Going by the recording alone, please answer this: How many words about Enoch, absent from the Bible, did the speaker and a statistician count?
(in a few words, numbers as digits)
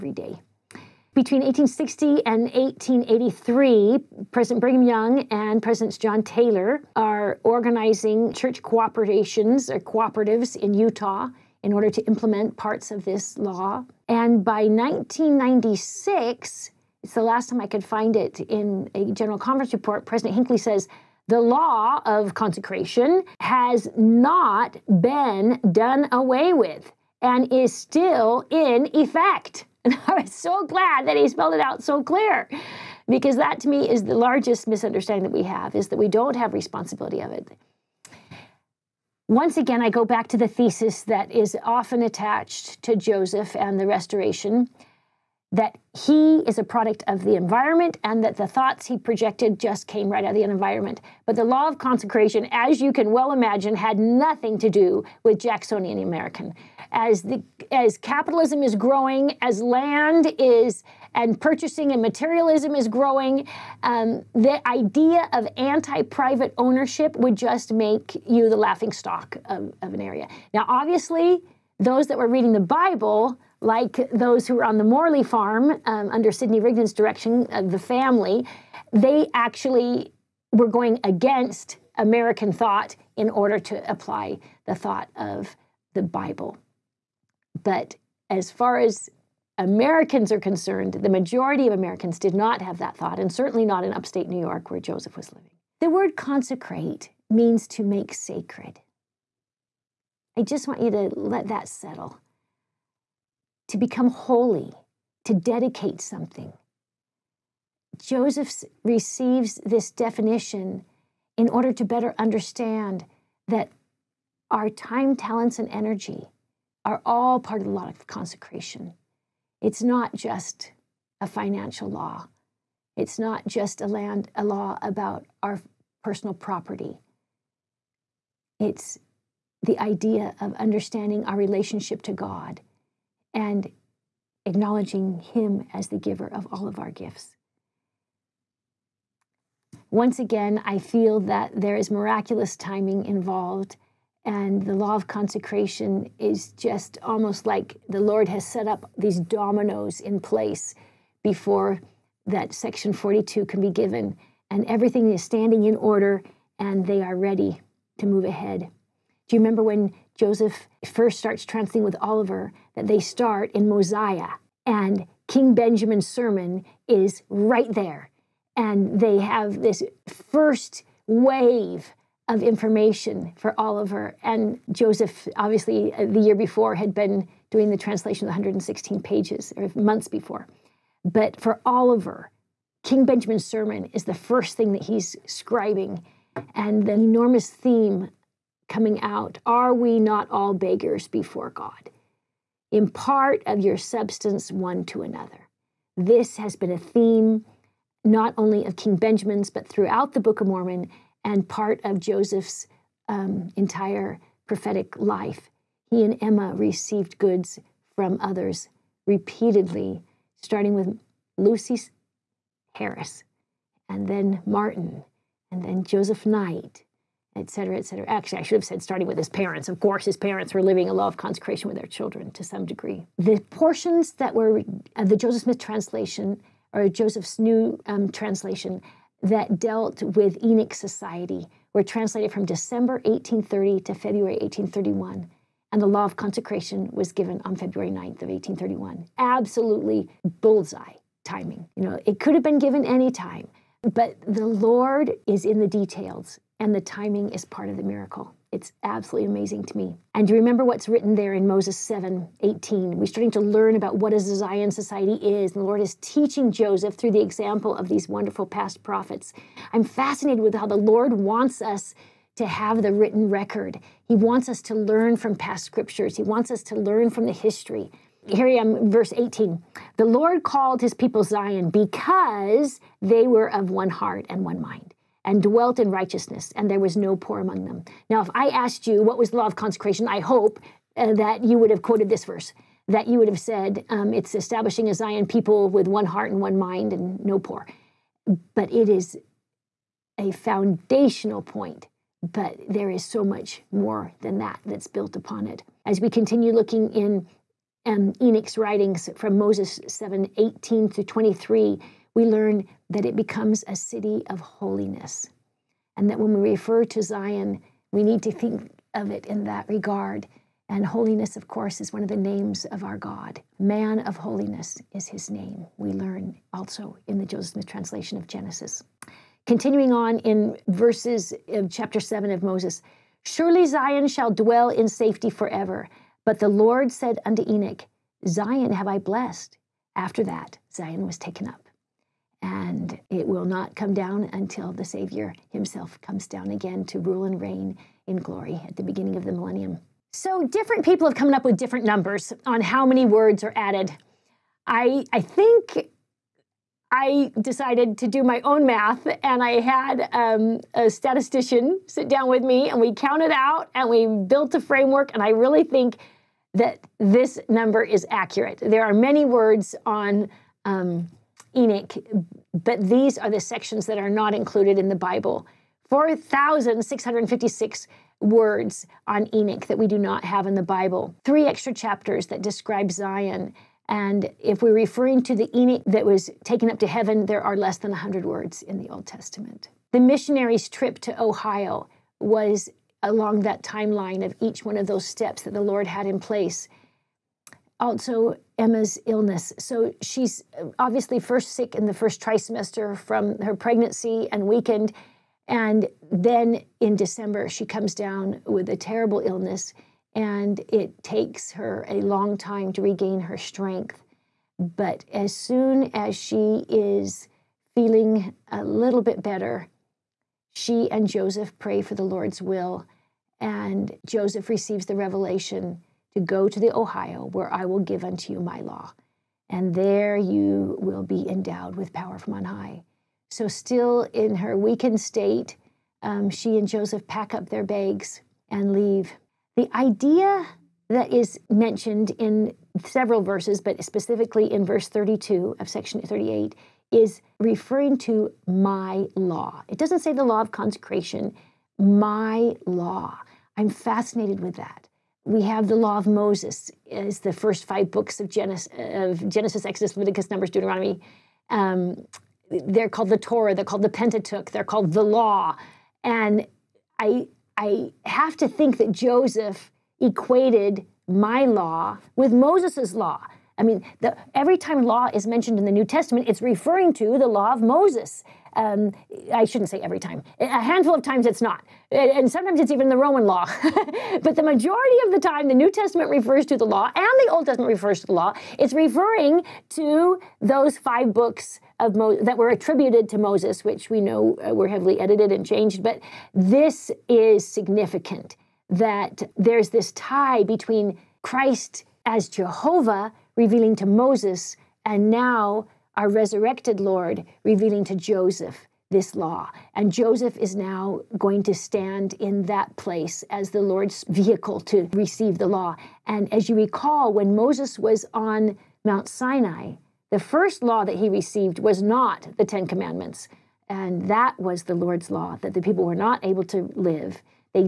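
4,656.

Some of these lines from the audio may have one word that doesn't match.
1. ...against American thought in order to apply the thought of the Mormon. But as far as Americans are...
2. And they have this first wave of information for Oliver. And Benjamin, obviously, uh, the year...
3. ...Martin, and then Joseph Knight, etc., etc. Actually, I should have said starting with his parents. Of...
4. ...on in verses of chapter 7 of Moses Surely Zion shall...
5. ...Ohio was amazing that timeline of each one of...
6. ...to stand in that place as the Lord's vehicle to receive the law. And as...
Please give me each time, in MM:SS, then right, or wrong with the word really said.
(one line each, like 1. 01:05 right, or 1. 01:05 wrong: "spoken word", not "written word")
1. 01:21 wrong: "Bible", not "Mormon"
2. 02:48 wrong: "Joseph", not "Benjamin"
3. 03:34 right
4. 05:19 right
5. 06:21 wrong: "along", not "amazing"
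6. 08:21 right.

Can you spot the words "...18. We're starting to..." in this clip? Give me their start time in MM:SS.
04:12.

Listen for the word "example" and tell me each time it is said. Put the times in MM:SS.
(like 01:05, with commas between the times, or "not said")
04:17.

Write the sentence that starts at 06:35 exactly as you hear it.
And then in December, she comes down with a terrible illness, and it takes her a long time to regain her strength.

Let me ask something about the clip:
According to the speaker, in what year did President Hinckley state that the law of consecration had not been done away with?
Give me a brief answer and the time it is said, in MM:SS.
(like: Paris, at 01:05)
1996, at 00:14.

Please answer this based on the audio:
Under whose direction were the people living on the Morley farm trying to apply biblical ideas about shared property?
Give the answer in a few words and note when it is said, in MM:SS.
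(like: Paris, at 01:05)
Sidney Rigdon, at 01:16.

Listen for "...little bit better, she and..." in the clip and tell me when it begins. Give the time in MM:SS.
06:48.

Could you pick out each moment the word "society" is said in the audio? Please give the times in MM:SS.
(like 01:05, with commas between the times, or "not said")
03:50, 04:14.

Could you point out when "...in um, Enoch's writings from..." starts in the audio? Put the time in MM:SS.
04:56.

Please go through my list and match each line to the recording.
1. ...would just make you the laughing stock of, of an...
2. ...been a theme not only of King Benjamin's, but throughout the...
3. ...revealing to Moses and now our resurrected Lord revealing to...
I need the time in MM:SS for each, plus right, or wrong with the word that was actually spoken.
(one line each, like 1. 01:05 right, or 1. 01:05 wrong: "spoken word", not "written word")
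1. 01:07 right
2. 03:16 right
3. 08:13 right.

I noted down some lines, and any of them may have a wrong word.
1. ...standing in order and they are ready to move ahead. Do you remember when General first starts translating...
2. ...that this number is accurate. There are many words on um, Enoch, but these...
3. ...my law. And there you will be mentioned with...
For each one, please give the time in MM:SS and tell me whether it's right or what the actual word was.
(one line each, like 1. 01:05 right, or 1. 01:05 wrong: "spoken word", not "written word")
1. 02:35 wrong: "Joseph", not "General"
2. 05:56 right
3. 06:58 wrong: "endowed", not "mentioned".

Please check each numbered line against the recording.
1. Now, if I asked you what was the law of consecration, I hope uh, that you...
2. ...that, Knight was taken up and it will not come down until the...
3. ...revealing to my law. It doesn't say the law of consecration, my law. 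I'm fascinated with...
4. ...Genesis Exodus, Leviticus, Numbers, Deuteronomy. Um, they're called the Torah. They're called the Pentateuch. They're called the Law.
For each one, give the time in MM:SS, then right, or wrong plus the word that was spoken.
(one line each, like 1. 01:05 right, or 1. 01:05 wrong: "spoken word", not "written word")
1. 04:38 right
2. 05:30 wrong: "Zion", not "Knight"
3. 07:17 wrong: "referring", not "revealing"
4. 07:29 right.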